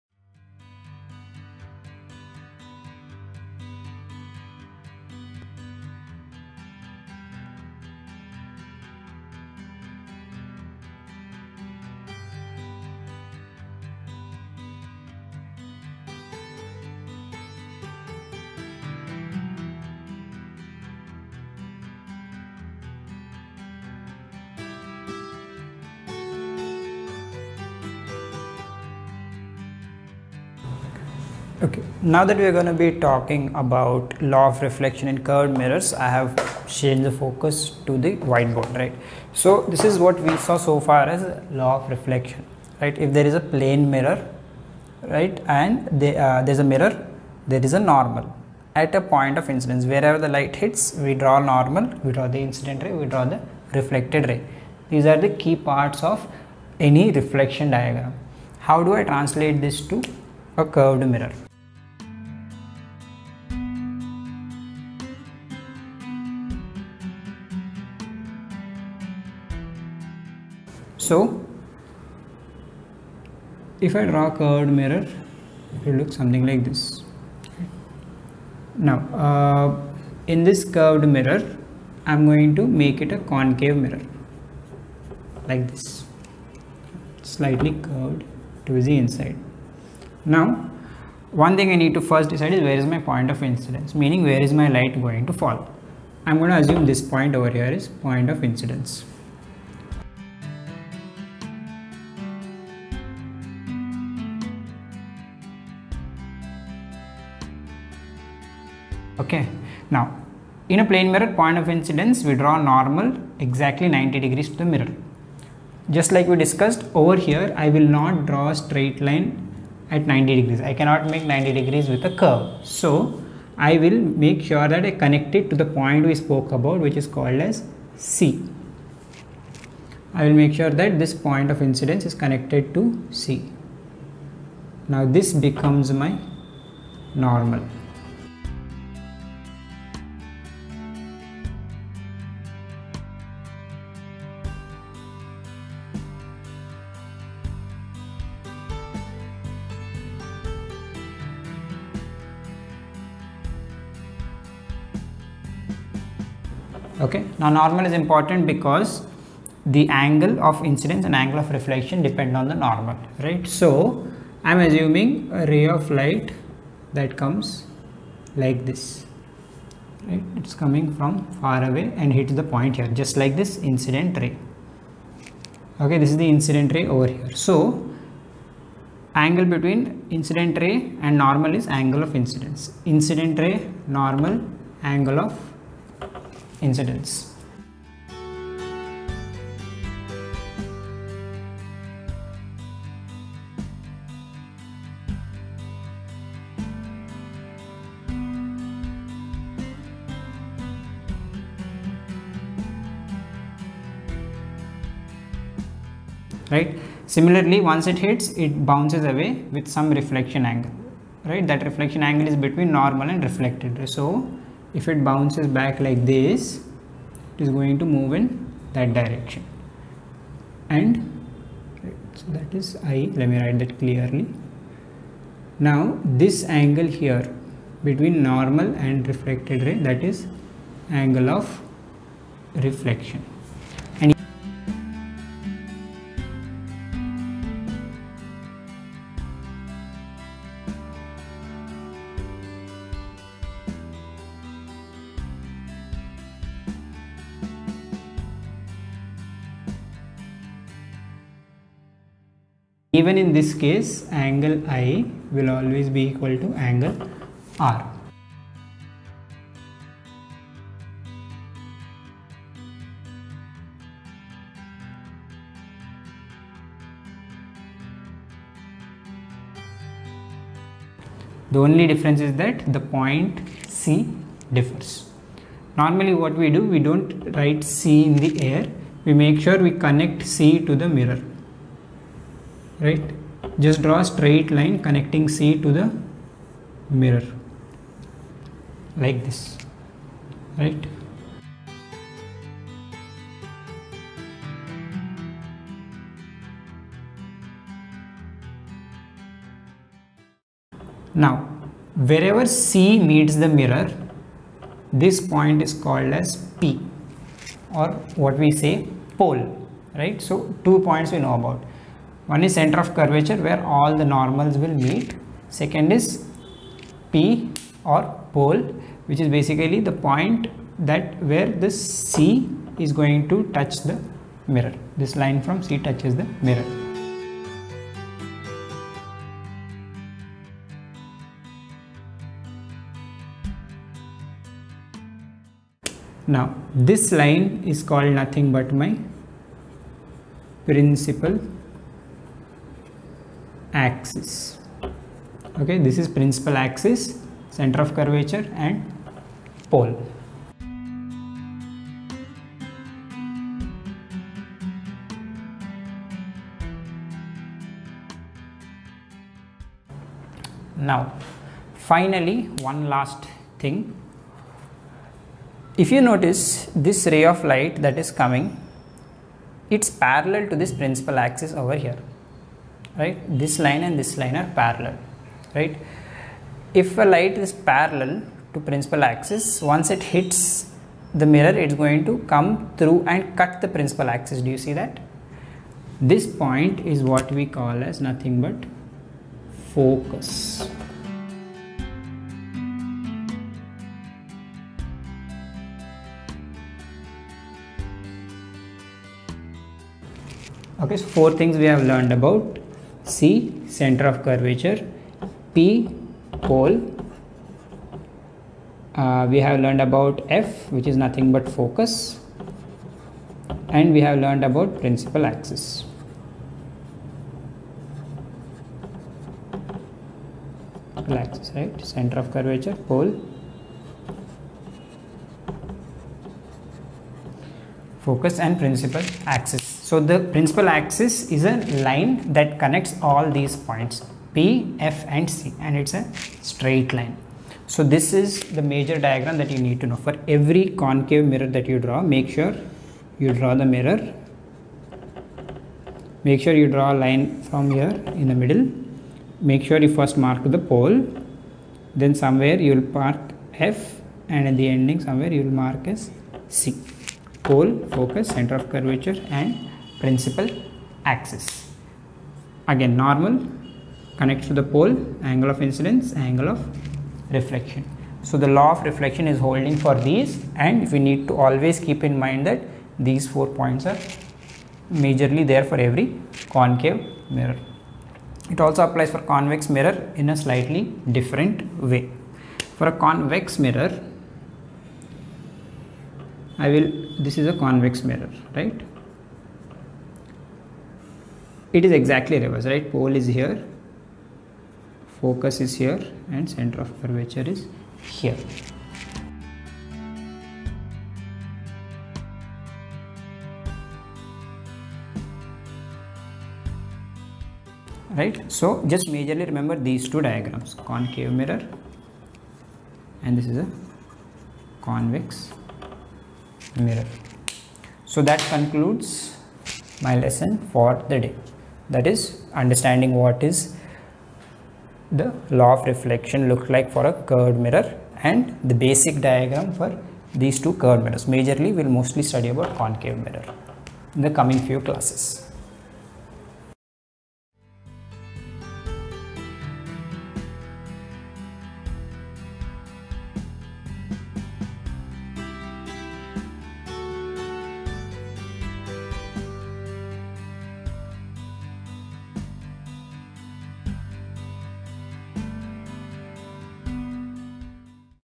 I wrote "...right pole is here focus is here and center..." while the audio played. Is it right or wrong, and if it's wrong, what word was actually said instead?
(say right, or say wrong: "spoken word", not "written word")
right.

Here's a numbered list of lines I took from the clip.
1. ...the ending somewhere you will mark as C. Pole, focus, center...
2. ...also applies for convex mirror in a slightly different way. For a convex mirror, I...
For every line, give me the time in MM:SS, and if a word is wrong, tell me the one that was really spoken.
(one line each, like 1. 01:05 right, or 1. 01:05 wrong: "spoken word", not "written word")
1. 07:34 right
2. 07:58 right.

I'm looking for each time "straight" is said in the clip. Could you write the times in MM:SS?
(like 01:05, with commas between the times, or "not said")
01:58, 04:44, 07:16.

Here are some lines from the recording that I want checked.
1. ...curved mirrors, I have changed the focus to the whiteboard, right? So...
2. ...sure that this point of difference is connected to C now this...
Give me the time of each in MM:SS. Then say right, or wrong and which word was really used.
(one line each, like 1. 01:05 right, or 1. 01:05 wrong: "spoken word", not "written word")
1. 00:35 right
2. 02:10 wrong: "incidence", not "difference".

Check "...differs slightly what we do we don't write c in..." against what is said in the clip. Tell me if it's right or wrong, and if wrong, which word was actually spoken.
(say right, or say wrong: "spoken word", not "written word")
wrong: "normally", not "slightly".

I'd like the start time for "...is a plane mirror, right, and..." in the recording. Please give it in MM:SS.
00:43.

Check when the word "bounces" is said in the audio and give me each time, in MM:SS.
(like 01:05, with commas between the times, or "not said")
03:28, 03:35.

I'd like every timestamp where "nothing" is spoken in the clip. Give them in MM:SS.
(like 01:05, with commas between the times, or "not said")
05:38, 06:28, 06:50.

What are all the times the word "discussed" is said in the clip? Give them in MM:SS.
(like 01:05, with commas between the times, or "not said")
01:56.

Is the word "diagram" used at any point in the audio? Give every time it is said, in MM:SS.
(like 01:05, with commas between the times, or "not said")
00:57, 07:18, 08:30, 08:49.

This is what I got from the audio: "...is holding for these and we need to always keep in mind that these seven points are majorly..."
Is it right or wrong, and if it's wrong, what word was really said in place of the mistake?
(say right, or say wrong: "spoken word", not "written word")
wrong: "four", not "seven".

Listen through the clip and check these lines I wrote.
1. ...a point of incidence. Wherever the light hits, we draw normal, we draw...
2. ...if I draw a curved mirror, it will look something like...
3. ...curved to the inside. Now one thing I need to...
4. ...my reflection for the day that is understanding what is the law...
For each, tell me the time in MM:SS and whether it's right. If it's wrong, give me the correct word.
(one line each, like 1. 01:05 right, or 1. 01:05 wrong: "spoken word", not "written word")
1. 00:48 right
2. 01:13 right
3. 01:27 right
4. 08:40 wrong: "lesson", not "reflection".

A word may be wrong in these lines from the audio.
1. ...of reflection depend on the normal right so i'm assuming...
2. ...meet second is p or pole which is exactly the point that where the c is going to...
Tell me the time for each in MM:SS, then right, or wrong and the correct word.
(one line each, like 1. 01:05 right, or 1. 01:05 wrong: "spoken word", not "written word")
1. 02:41 right
2. 05:14 wrong: "basically", not "exactly".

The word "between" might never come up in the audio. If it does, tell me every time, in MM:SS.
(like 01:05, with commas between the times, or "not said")
02:59, 03:32, 03:47.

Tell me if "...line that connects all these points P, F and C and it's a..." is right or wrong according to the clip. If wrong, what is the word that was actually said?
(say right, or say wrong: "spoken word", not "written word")
right.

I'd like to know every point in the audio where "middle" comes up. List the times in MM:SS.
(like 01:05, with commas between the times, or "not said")
07:28.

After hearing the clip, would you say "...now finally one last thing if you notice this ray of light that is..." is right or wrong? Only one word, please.
right.